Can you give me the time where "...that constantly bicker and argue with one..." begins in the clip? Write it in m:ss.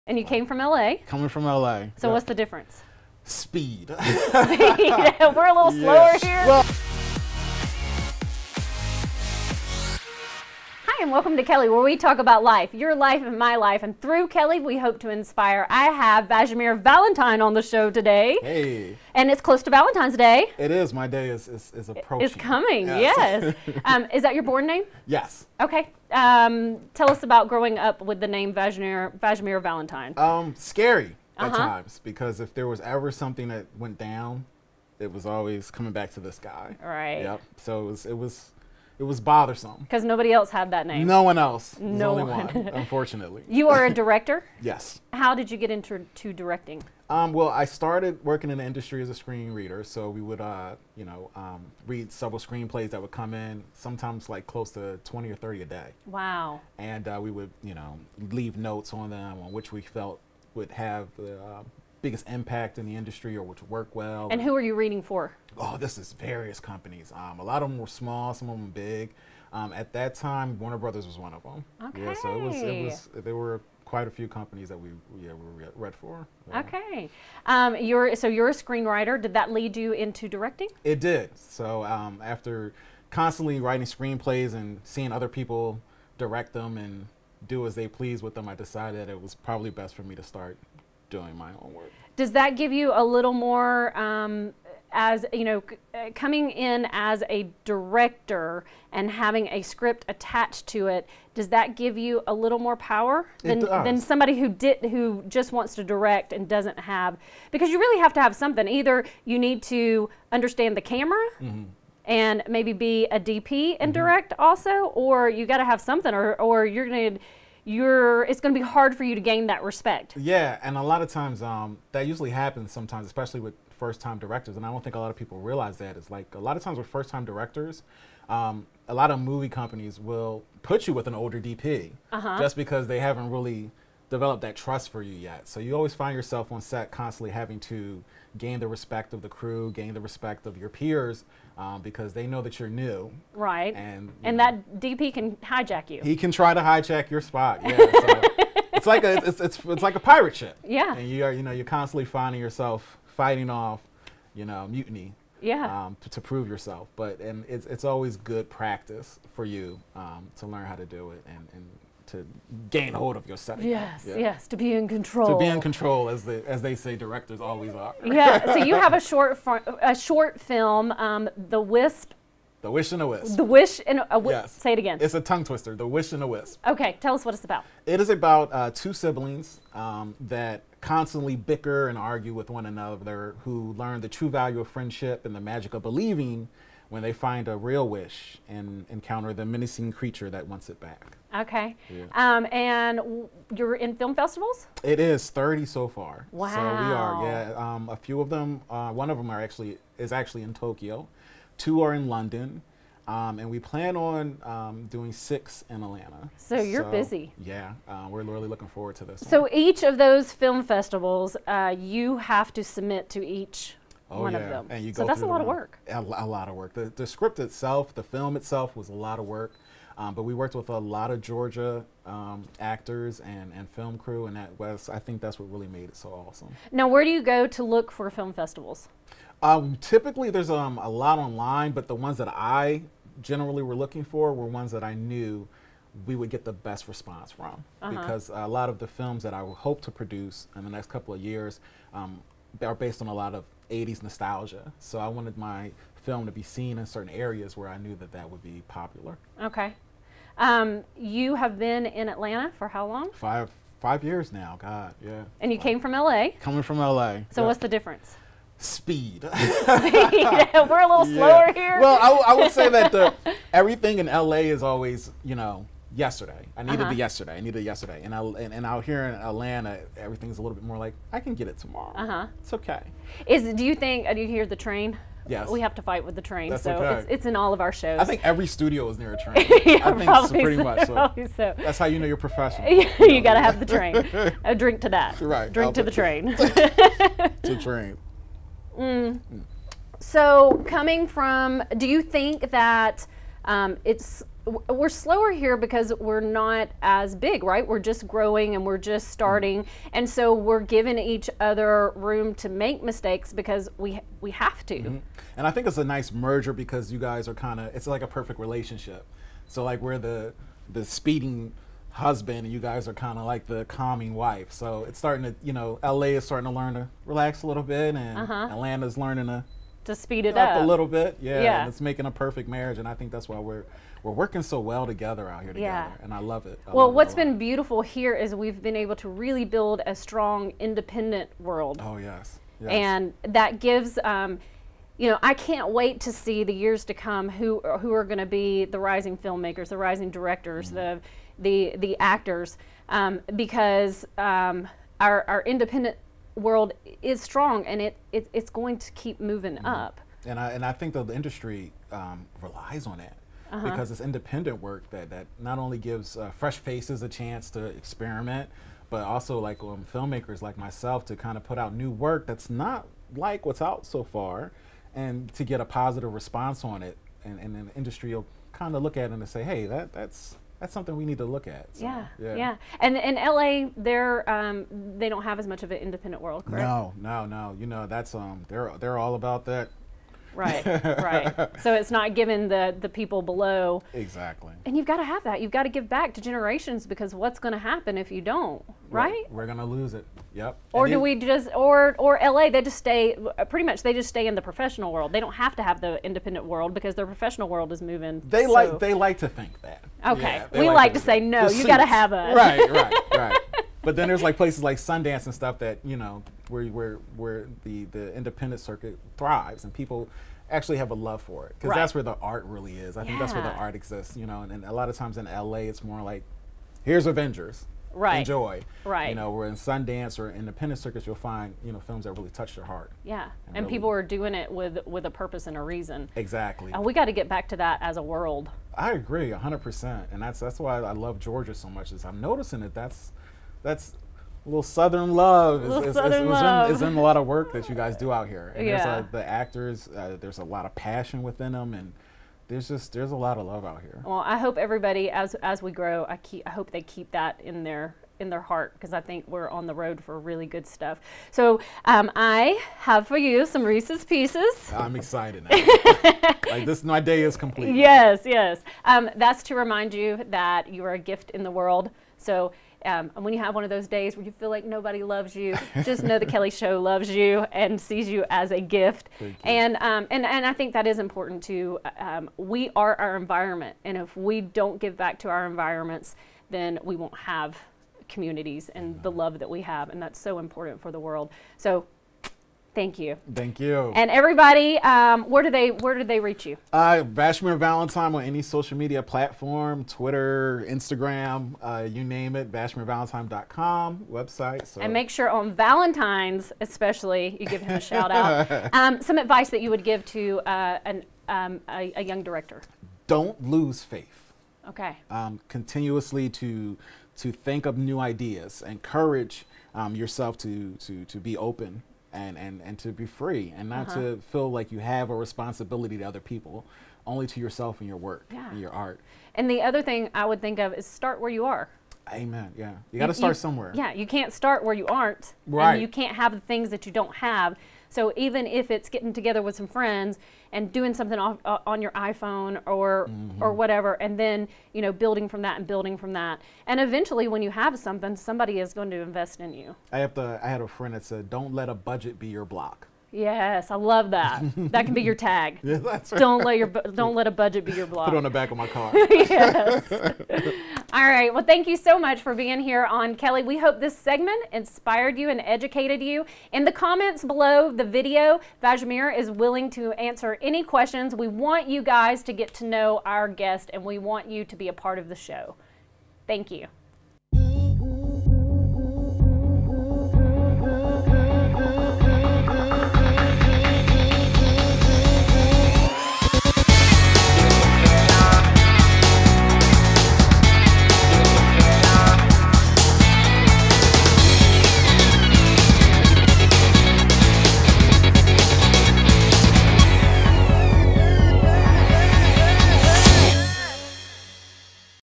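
3:00.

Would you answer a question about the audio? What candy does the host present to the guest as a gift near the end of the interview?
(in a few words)
Reese's Pieces.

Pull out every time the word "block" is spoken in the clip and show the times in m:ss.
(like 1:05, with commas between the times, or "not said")
9:02, 9:07.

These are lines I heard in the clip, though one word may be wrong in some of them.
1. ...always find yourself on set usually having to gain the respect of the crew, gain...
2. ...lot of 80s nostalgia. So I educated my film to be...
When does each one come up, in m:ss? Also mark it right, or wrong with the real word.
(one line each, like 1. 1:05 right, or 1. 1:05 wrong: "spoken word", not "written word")
1. 2:15 wrong: "constantly", not "usually"
2. 4:03 wrong: "wanted", not "educated".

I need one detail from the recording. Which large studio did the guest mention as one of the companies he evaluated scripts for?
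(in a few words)
Warner Brothers.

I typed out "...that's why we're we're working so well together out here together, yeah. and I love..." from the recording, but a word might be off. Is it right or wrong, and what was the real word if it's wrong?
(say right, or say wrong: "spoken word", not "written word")
right.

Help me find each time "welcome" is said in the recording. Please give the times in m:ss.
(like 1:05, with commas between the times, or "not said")
0:11.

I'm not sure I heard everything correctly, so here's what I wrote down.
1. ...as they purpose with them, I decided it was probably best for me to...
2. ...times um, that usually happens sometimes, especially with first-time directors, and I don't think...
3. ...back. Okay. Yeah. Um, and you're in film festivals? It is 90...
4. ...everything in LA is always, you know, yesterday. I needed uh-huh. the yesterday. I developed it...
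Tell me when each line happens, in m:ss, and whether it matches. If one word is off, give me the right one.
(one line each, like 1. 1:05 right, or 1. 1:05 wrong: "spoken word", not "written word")
1. 1:27 wrong: "please", not "purpose"
2. 2:01 right
3. 3:10 wrong: "30", not "90"
4. 4:23 wrong: "needed", not "developed".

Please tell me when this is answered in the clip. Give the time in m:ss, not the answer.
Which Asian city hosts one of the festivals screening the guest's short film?
3:20.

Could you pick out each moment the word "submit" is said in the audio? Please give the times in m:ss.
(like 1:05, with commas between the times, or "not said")
3:32.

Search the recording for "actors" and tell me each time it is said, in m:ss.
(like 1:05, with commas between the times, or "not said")
3:42, 5:41, 7:19.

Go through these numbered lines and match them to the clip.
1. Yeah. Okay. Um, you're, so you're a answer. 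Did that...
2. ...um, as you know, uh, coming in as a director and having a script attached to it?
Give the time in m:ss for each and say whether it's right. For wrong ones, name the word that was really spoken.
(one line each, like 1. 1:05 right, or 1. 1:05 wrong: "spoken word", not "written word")
1. 1:16 wrong: "screenwriter", not "answer"
2. 1:33 right.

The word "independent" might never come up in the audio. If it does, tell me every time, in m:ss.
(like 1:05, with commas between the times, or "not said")
5:30, 5:45, 5:54, 6:15, 6:36, 6:48, 7:00.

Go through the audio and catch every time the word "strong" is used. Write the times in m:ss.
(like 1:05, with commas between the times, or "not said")
5:29, 5:47.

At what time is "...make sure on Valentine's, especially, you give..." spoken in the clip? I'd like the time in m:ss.
8:14.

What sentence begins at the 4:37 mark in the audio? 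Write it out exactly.
I think every studio is near a train.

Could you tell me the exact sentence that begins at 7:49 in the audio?
And, um, and, and I think that is important too.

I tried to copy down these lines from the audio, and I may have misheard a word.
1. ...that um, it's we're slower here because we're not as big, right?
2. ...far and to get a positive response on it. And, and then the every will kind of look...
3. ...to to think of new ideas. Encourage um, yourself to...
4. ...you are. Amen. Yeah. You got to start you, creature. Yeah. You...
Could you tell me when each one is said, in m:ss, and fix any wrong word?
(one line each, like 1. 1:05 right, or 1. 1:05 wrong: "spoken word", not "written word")
1. 4:52 right
2. 6:04 wrong: "industry", not "every"
3. 8:26 right
4. 8:41 wrong: "somewhere", not "creature".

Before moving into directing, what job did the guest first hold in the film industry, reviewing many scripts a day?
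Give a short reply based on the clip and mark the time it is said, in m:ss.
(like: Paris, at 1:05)
Screen reader, at 0:49.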